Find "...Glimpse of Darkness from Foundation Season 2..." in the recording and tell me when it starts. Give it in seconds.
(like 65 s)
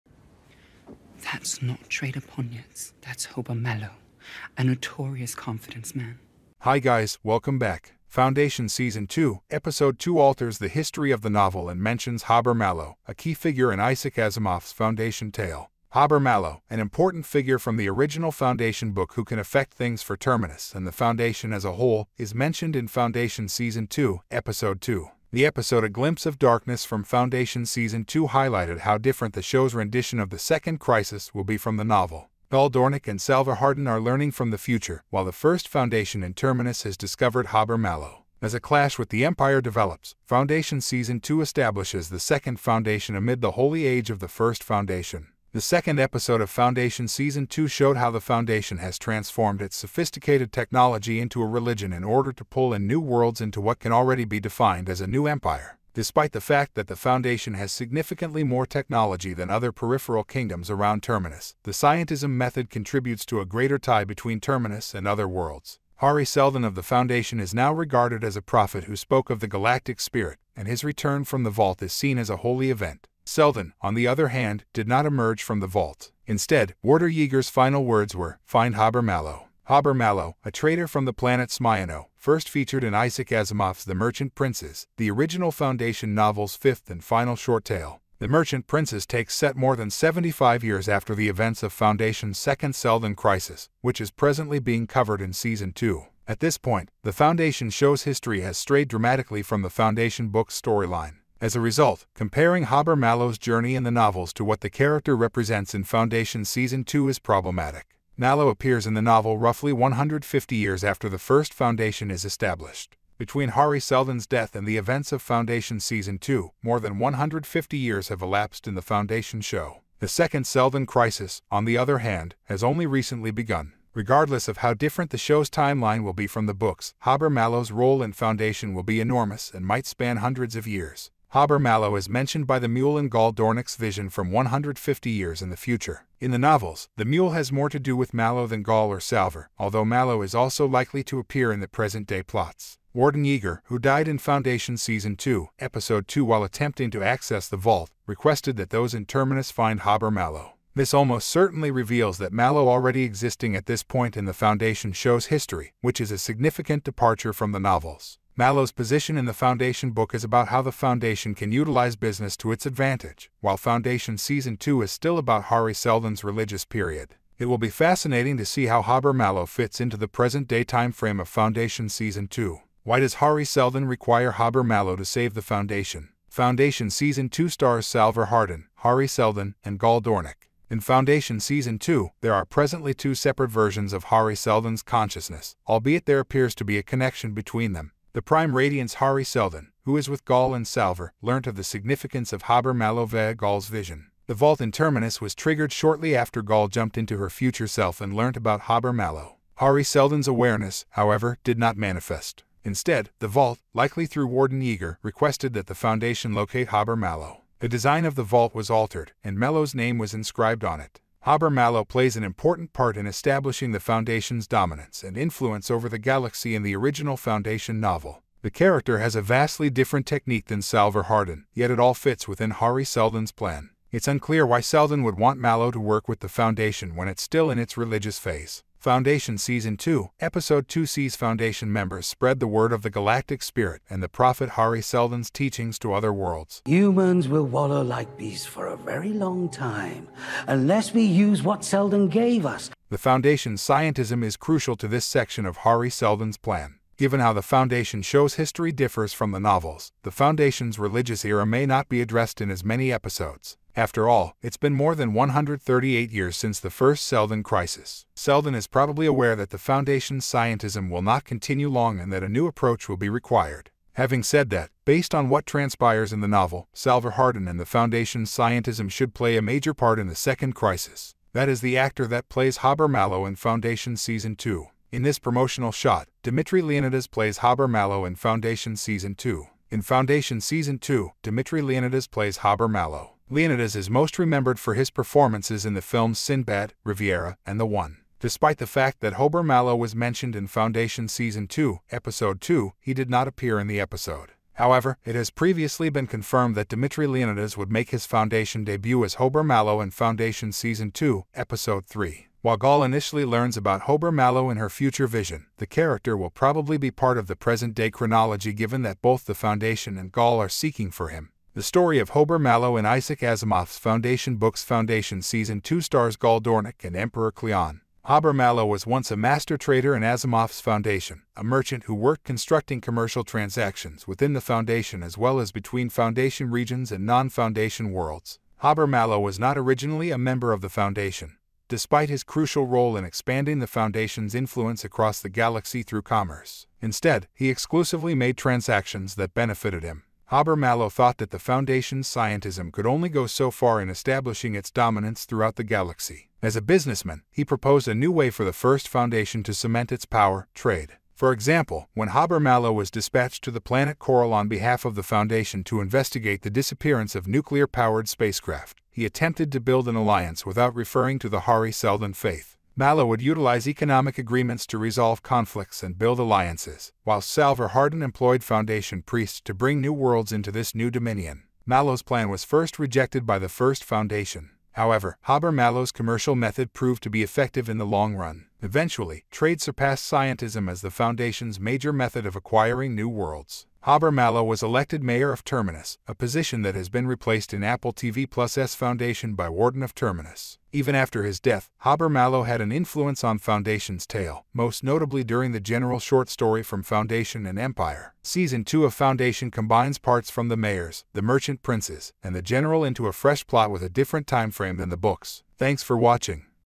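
25 s.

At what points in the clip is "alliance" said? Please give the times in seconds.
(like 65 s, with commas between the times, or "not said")
359 s, 366 s.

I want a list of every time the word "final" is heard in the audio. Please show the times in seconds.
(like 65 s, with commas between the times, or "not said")
77 s, 87 s.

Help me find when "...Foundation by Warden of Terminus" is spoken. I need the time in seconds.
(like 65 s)
388 s.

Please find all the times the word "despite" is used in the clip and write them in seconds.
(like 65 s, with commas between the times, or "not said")
55 s, 288 s, 331 s.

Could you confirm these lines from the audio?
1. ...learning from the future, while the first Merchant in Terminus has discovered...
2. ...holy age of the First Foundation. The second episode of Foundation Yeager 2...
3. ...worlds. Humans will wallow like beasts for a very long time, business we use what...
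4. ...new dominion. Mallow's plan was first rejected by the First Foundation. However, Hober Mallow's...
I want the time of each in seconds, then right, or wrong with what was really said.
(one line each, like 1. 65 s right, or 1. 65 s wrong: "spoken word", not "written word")
1. 34 s wrong: "Foundation", not "Merchant"
2. 43 s wrong: "Season", not "Yeager"
3. 236 s wrong: "unless", not "business"
4. 370 s right.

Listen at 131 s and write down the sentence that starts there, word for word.
Hober Mallow is mentioned by the mule in Gaal Dornick's vision from 150 years in the future.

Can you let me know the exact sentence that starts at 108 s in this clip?
Mallow appears in the novel roughly 150 years after the first Foundation is established.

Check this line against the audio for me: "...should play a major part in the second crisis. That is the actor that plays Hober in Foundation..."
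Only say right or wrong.
right.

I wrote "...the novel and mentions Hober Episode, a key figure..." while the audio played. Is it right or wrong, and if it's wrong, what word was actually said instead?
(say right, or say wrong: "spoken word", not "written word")
wrong: "Mallow", not "Episode".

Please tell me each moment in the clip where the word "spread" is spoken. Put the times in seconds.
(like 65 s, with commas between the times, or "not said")
232 s.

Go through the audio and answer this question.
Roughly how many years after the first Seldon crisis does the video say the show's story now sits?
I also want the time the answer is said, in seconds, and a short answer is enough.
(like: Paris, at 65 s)
138, at 255 s.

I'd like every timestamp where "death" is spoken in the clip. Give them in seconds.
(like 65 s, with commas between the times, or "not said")
114 s, 391 s.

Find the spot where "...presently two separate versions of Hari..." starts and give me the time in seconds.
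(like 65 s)
182 s.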